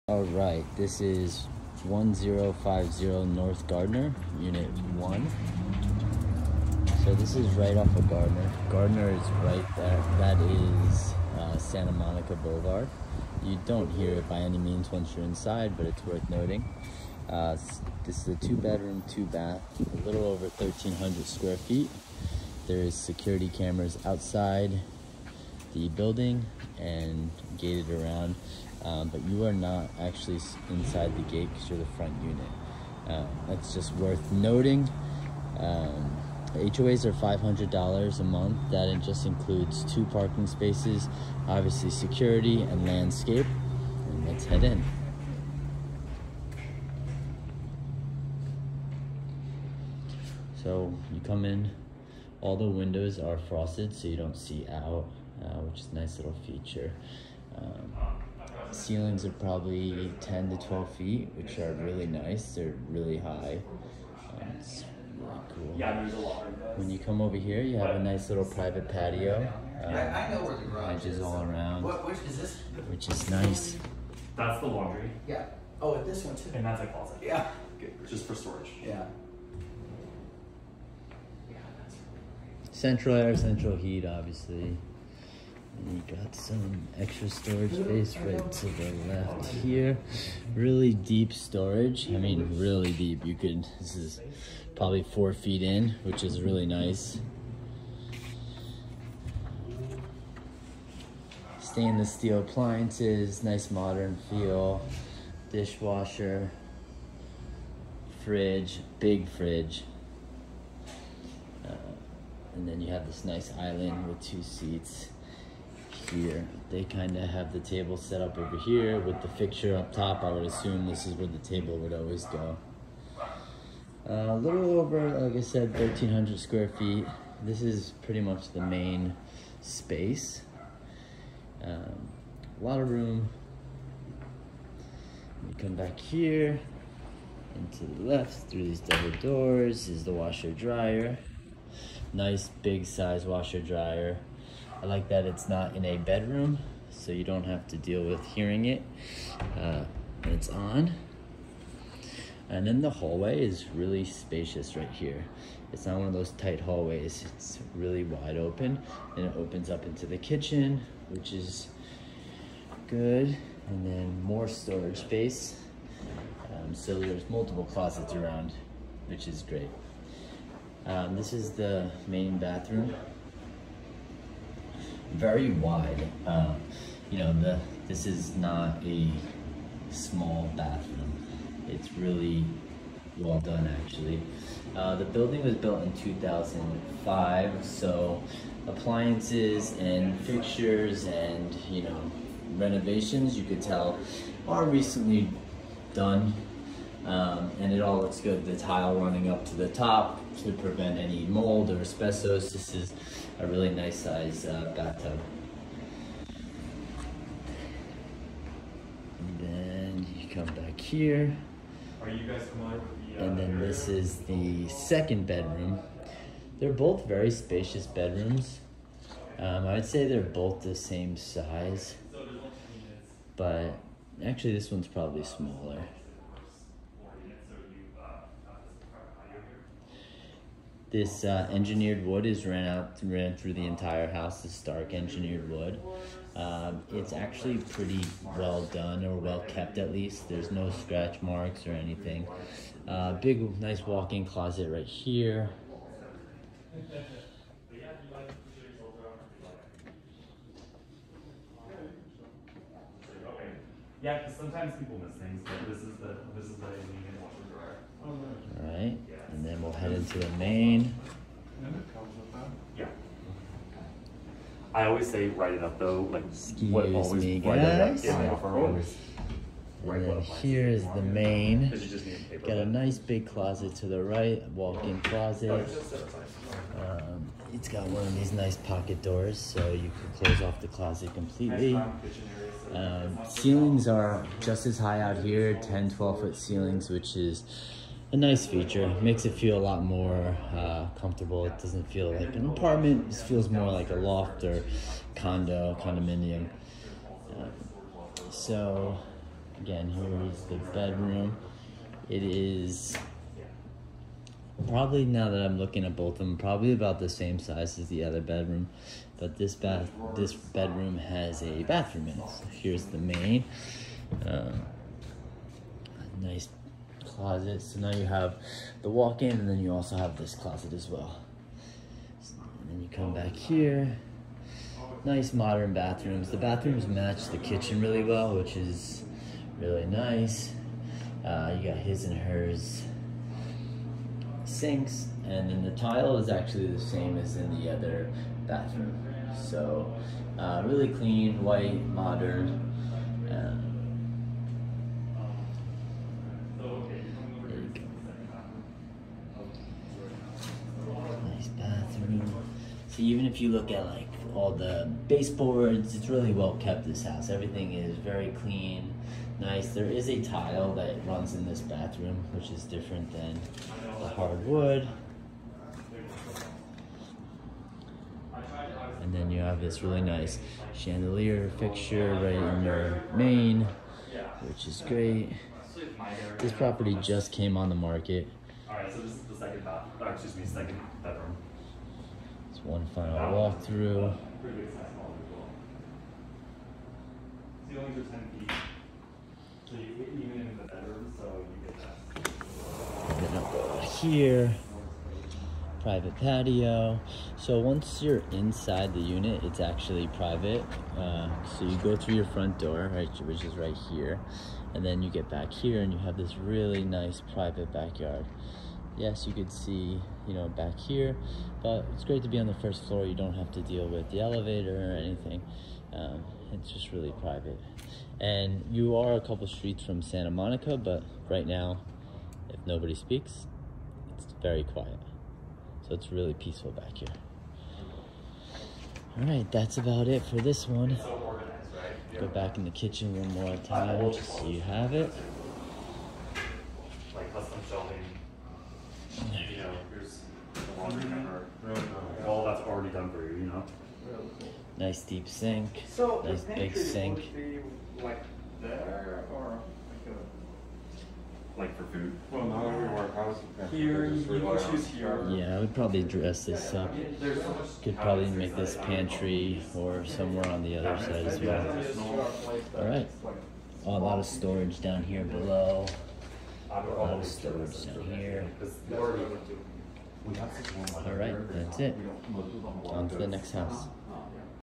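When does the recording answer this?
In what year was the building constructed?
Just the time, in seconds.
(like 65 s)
185 s.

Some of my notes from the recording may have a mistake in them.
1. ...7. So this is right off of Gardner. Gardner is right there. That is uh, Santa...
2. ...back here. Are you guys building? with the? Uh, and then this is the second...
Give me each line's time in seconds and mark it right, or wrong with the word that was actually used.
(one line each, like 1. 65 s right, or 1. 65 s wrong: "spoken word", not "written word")
1. 4 s wrong: "1", not "7"
2. 210 s wrong: "coming", not "building".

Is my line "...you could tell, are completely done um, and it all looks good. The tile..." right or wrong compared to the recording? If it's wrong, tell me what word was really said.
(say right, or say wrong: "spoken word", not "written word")
wrong: "recently", not "completely".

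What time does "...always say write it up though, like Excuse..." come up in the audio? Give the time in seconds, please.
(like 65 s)
264 s.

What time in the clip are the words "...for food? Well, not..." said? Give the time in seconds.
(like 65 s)
451 s.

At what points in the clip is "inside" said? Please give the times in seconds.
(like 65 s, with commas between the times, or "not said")
15 s, 30 s, 398 s.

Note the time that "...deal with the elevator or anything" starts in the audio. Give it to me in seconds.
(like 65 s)
413 s.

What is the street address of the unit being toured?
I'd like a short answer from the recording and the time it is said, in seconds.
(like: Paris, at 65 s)
1050 North Gardner, at 1 s.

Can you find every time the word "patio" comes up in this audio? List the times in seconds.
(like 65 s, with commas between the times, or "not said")
68 s, 396 s.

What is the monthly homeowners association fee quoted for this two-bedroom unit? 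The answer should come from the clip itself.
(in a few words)
$500.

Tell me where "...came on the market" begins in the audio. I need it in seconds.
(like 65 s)
377 s.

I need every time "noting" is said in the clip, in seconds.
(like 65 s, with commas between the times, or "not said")
16 s, 34 s.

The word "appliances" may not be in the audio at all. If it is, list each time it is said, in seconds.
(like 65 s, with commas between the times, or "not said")
102 s, 188 s.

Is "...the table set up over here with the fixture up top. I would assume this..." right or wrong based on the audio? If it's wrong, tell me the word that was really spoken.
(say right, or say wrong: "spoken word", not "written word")
right.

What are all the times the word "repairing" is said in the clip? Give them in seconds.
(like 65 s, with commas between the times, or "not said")
not said.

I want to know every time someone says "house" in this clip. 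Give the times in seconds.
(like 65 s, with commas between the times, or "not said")
234 s, 357 s, 473 s.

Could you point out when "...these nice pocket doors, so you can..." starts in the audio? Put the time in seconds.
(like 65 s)
278 s.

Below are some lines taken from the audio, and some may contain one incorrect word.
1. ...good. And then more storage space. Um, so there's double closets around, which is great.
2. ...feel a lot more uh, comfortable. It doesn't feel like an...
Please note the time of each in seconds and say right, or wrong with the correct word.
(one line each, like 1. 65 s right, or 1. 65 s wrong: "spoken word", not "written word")
1. 162 s wrong: "multiple", not "double"
2. 289 s right.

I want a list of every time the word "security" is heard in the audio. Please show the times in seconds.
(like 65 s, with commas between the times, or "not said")
22 s, 41 s.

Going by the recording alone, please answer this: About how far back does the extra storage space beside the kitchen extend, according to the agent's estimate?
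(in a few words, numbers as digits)
4 feet.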